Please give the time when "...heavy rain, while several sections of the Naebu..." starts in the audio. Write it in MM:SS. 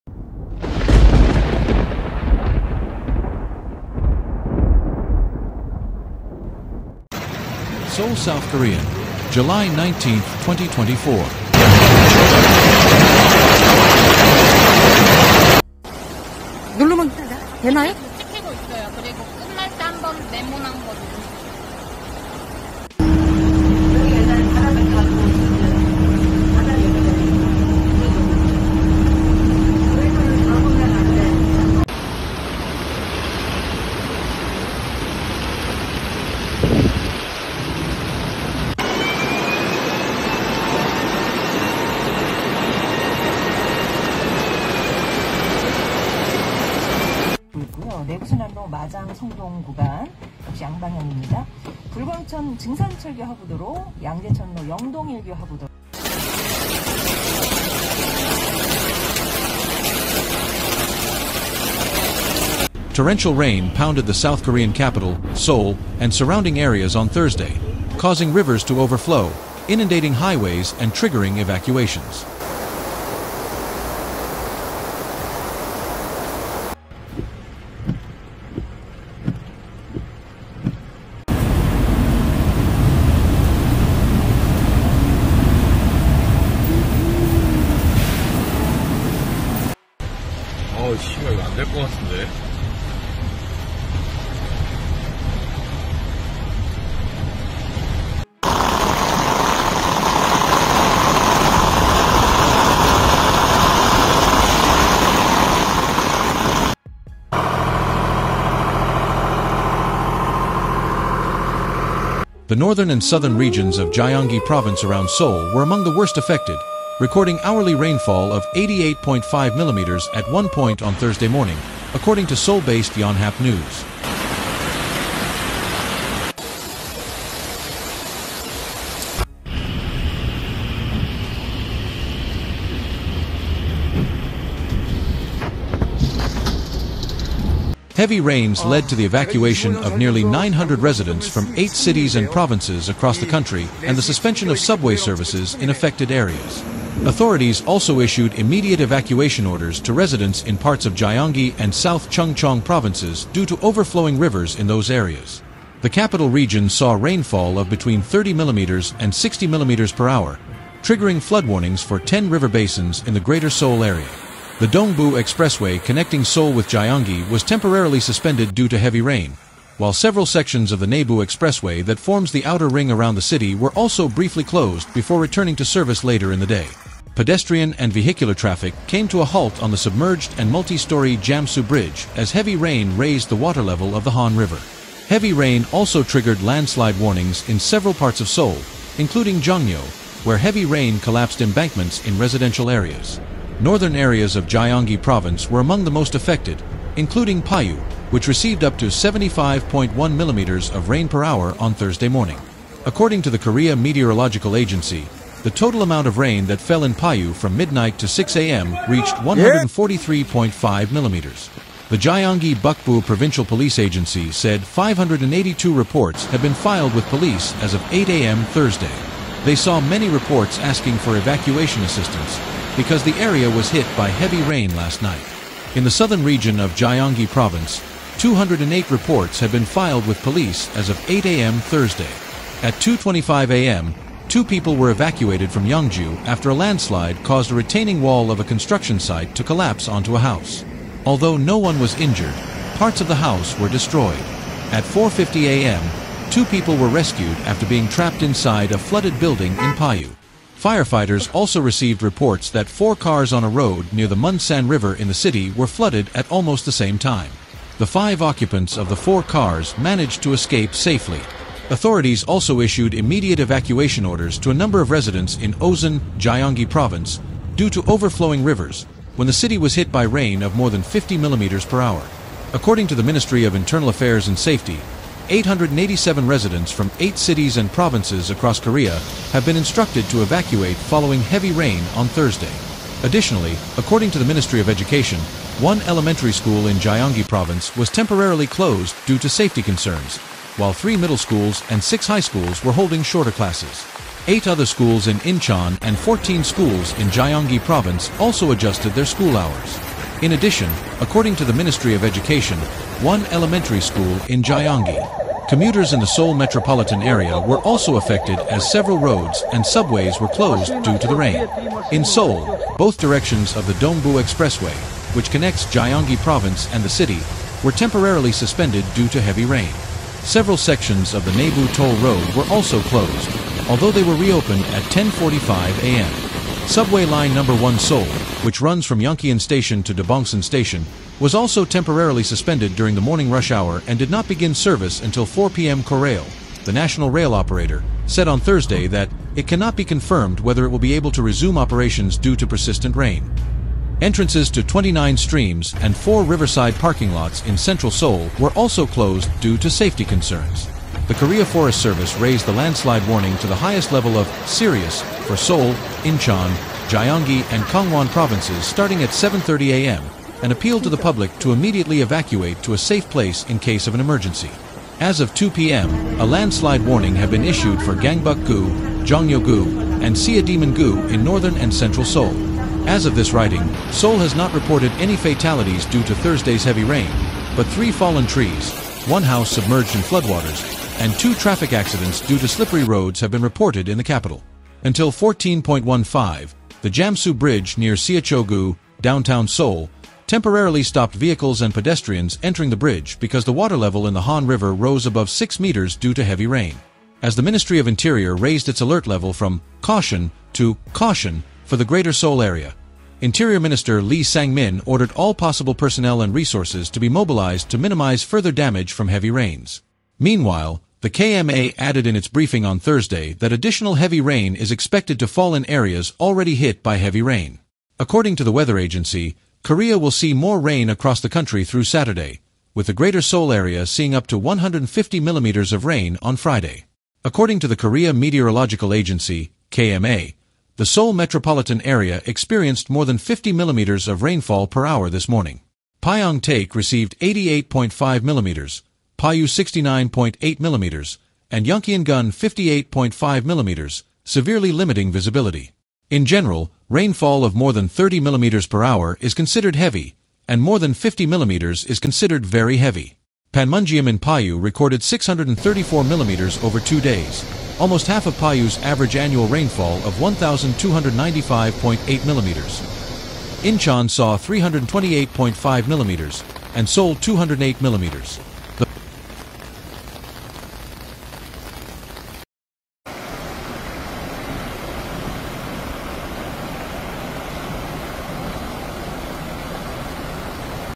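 02:48.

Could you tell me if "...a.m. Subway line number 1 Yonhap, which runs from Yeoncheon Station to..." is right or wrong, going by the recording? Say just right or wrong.
wrong.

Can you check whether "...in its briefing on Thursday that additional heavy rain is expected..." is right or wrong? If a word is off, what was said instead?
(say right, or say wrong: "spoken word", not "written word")
right.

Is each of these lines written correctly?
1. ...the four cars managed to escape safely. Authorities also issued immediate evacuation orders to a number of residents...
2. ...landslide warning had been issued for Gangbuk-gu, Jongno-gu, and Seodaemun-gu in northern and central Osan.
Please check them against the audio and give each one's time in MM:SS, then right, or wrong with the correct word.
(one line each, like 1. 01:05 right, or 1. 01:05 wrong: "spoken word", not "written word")
1. 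04:18 right
2. 06:06 wrong: "Seoul", not "Osan".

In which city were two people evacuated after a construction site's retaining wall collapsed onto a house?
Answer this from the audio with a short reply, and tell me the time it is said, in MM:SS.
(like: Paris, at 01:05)
Yangju, at 03:55.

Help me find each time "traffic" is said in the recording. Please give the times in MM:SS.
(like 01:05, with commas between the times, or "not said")
02:58, 06:21.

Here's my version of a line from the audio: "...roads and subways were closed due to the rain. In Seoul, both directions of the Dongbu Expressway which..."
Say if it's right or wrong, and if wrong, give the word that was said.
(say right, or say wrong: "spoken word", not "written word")
right.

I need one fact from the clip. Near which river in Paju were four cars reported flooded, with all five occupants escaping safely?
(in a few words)
Munsan River.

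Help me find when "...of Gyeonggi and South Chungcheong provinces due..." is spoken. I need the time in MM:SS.
02:30.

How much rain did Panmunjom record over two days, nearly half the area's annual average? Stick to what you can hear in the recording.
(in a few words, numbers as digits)
634 millimeters.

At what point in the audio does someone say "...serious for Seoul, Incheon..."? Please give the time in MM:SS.
05:54.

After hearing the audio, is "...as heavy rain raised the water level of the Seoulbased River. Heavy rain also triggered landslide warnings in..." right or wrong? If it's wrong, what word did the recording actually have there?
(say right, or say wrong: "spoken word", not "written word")
wrong: "Han", not "Seoulbased".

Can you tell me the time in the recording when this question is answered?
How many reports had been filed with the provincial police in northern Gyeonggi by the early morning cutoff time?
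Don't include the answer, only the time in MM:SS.
03:34.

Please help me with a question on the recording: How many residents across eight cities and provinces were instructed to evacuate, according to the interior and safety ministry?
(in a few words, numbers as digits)
887.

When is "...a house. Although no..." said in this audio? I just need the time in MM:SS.
04:00.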